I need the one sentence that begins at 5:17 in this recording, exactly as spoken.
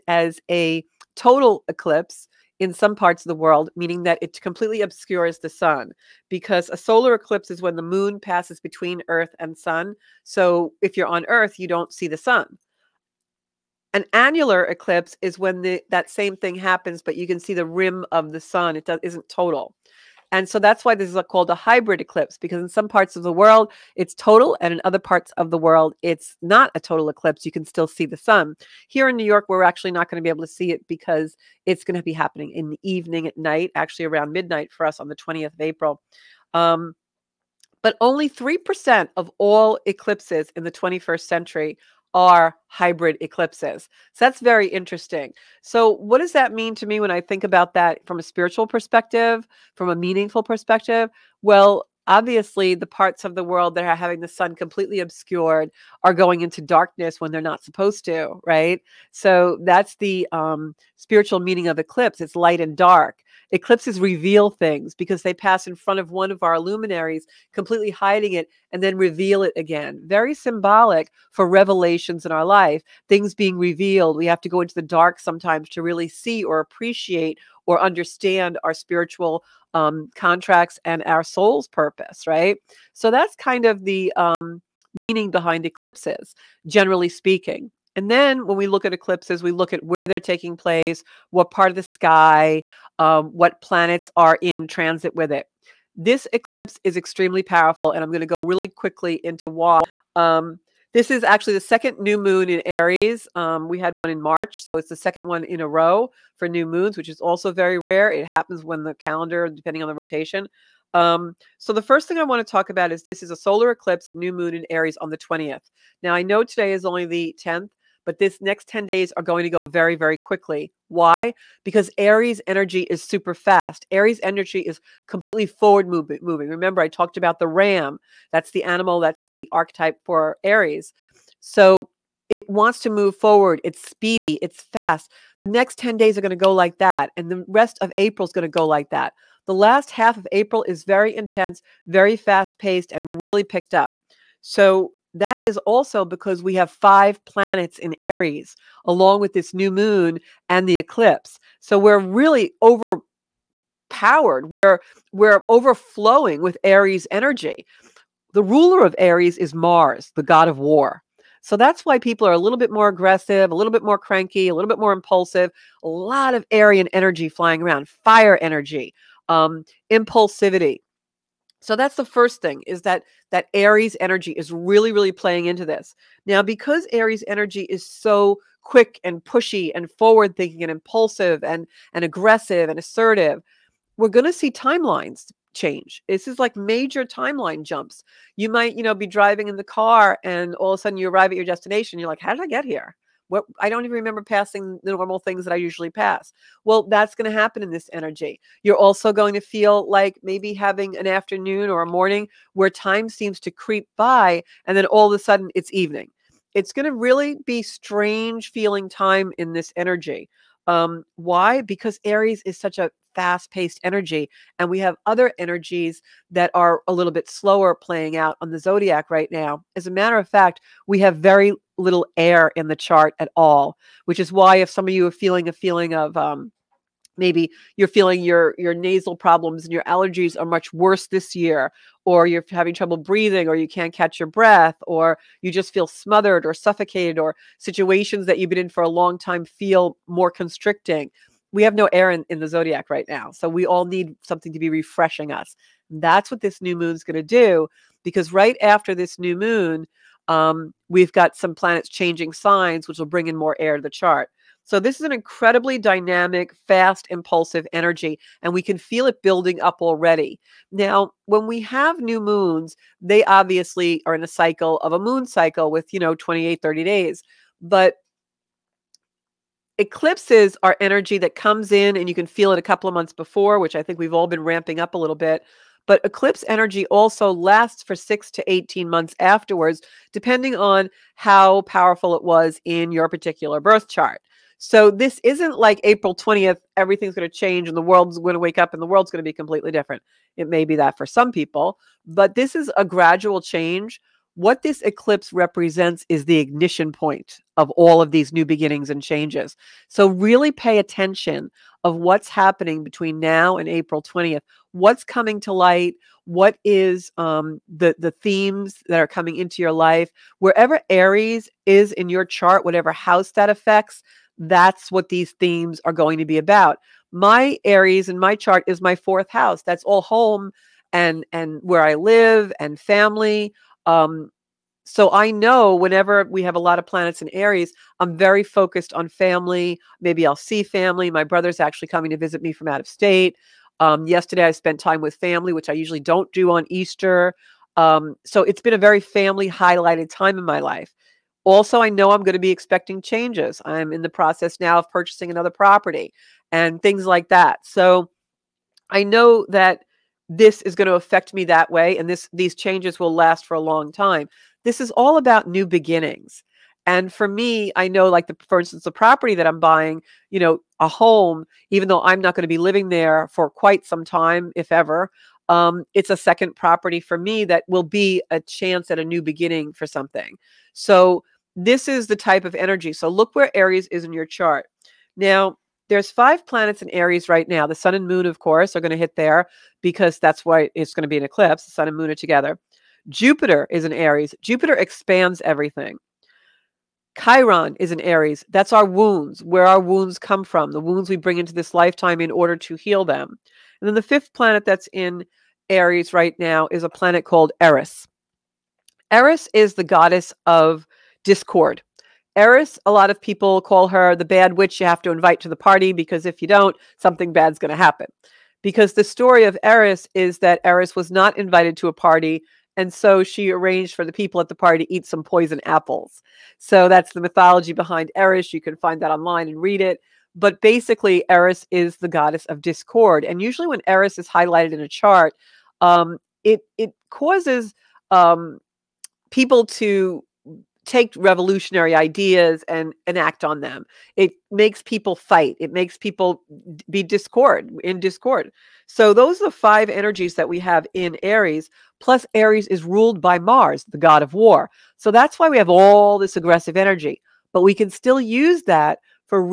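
My Aries in my chart is my fourth house.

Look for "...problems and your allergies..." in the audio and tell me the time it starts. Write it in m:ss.
3:49.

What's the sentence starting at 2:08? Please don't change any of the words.
That's the animal, that's the archetype for Aries.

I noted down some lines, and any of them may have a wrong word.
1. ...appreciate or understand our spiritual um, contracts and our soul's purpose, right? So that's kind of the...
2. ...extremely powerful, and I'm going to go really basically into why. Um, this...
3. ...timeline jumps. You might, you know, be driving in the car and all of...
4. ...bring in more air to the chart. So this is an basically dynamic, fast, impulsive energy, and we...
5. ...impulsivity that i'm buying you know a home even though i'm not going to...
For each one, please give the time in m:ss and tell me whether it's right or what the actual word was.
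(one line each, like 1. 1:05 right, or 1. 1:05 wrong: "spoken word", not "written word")
1. 1:16 right
2. 1:36 wrong: "quickly", not "basically"
3. 3:07 right
4. 4:13 wrong: "incredibly", not "basically"
5. 5:58 wrong: "property", not "impulsivity".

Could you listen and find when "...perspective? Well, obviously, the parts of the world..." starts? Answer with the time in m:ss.
0:50.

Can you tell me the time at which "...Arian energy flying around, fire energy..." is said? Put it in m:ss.
2:46.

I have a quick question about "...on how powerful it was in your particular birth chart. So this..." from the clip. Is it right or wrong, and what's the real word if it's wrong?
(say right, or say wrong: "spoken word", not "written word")
right.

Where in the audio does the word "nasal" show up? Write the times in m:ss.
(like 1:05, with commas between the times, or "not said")
3:48.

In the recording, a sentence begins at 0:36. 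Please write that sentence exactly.
Um, but only 3% of all eclipses in the 21st century are hybrid eclipses.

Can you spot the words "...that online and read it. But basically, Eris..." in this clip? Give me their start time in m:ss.
6:59.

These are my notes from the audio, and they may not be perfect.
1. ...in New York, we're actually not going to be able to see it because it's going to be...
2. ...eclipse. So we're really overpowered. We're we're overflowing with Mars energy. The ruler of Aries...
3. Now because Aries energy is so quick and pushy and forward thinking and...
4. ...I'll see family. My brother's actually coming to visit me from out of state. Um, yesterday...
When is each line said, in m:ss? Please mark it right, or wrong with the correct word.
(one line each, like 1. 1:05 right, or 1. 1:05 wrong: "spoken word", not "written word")
1. 0:29 right
2. 2:30 wrong: "Aries", not "Mars"
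3. 2:56 right
4. 5:30 right.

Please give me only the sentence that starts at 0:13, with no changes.
An annular eclipse is when the, that same thing happens, but you can see the rim of the sun.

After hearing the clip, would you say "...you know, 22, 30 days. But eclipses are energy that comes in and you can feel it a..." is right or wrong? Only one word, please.
wrong.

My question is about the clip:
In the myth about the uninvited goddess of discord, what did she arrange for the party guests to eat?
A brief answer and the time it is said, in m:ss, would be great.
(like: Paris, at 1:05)
poison apples, at 6:55.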